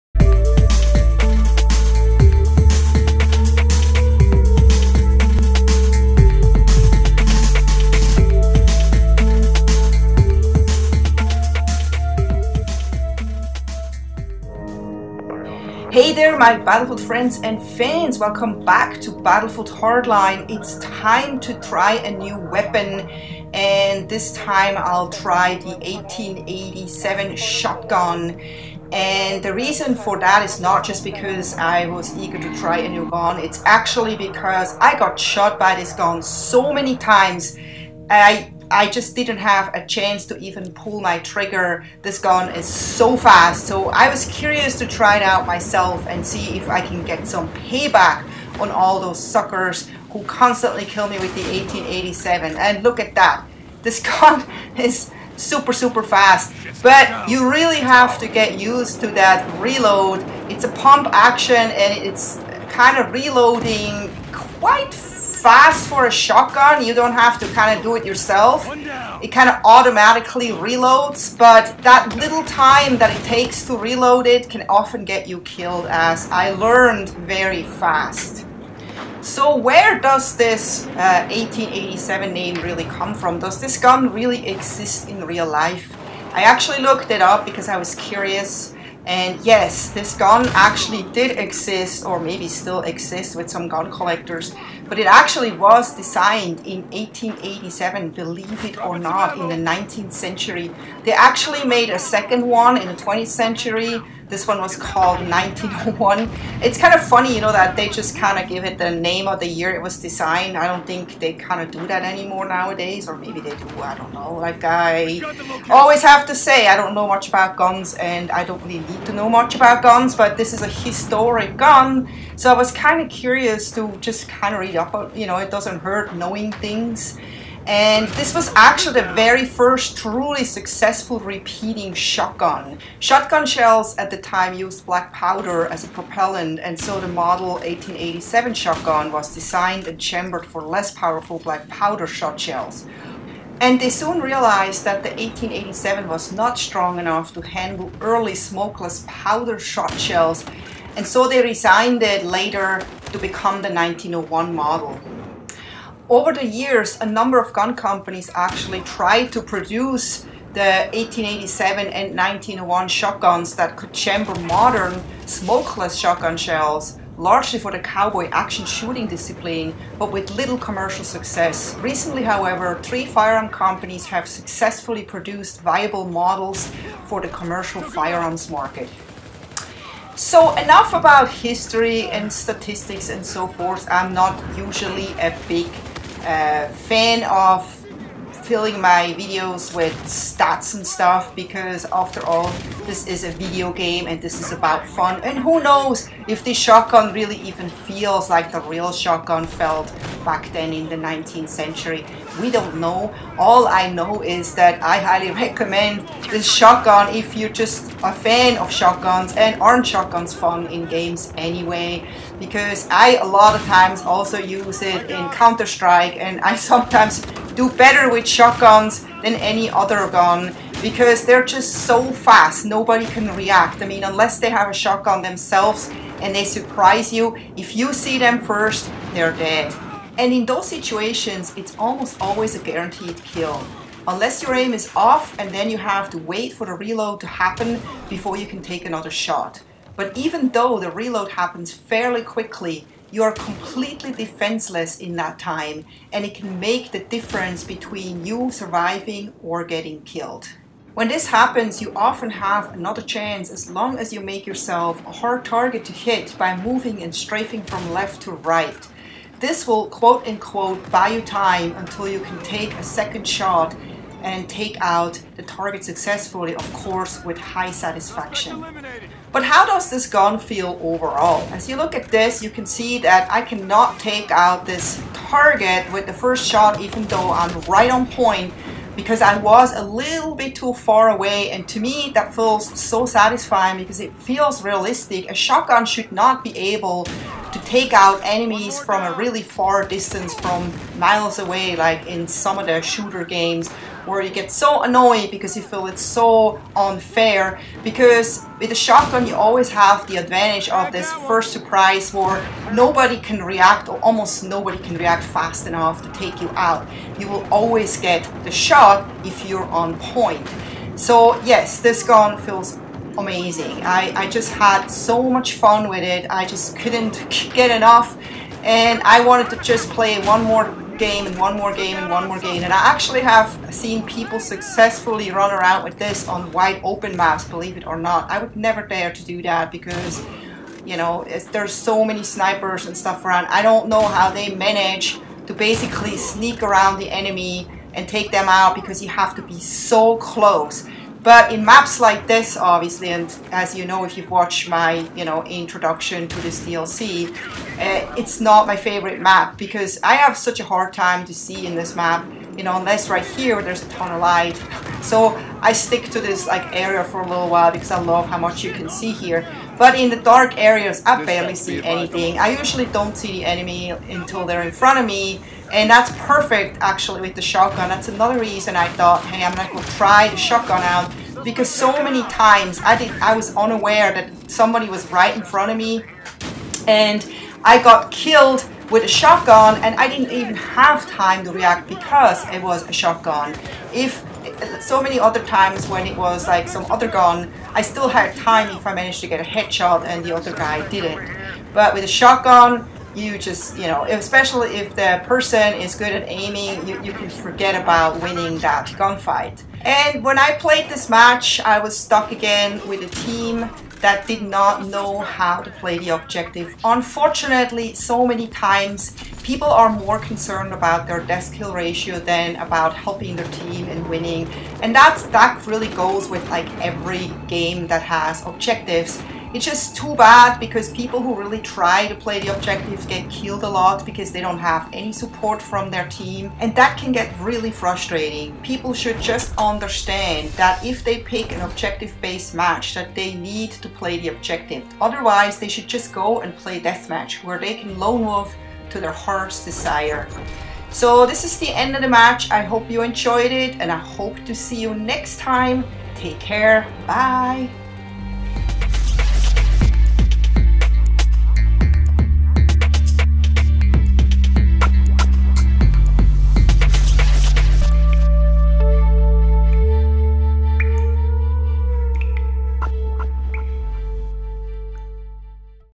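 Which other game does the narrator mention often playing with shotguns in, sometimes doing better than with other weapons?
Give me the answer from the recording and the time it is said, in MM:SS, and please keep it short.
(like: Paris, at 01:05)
Counter-Strike, at 03:35.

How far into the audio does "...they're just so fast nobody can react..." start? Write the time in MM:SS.
03:41.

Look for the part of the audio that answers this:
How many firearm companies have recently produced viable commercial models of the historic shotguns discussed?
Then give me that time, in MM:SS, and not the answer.
02:52.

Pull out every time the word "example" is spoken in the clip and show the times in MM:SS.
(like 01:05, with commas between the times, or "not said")
not said.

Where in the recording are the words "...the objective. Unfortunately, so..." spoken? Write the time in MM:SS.
06:45.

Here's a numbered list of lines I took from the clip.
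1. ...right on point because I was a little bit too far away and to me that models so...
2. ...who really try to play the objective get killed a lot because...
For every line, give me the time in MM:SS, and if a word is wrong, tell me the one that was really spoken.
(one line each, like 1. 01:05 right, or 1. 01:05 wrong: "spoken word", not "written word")
1. 04:37 wrong: "feels", not "models"
2. 07:01 right.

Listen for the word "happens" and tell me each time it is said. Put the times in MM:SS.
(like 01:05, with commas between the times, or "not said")
03:57, 04:01, 04:11.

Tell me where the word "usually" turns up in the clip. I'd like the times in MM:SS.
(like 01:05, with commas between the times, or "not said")
03:04, 06:02.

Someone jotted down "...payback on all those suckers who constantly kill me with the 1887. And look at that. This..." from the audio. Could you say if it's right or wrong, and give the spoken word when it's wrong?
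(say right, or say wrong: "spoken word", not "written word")
right.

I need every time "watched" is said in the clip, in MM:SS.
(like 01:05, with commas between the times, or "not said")
05:44.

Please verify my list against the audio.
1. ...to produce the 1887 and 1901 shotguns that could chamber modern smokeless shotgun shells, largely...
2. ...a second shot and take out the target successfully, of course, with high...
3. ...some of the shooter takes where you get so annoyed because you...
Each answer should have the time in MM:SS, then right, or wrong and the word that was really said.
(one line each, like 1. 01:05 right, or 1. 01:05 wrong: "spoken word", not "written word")
1. 02:39 right
2. 04:22 right
3. 04:52 wrong: "games", not "takes".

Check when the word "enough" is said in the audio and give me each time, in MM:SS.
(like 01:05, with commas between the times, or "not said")
02:26, 03:00, 05:05, 05:17.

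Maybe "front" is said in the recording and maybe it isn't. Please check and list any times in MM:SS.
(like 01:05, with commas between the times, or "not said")
06:04, 06:15.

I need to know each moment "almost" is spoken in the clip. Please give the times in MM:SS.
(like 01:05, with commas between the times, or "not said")
03:51, 05:03.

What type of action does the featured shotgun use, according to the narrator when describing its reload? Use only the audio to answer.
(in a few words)
Pump action.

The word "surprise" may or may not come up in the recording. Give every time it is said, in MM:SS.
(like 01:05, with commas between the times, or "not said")
03:46, 05:01.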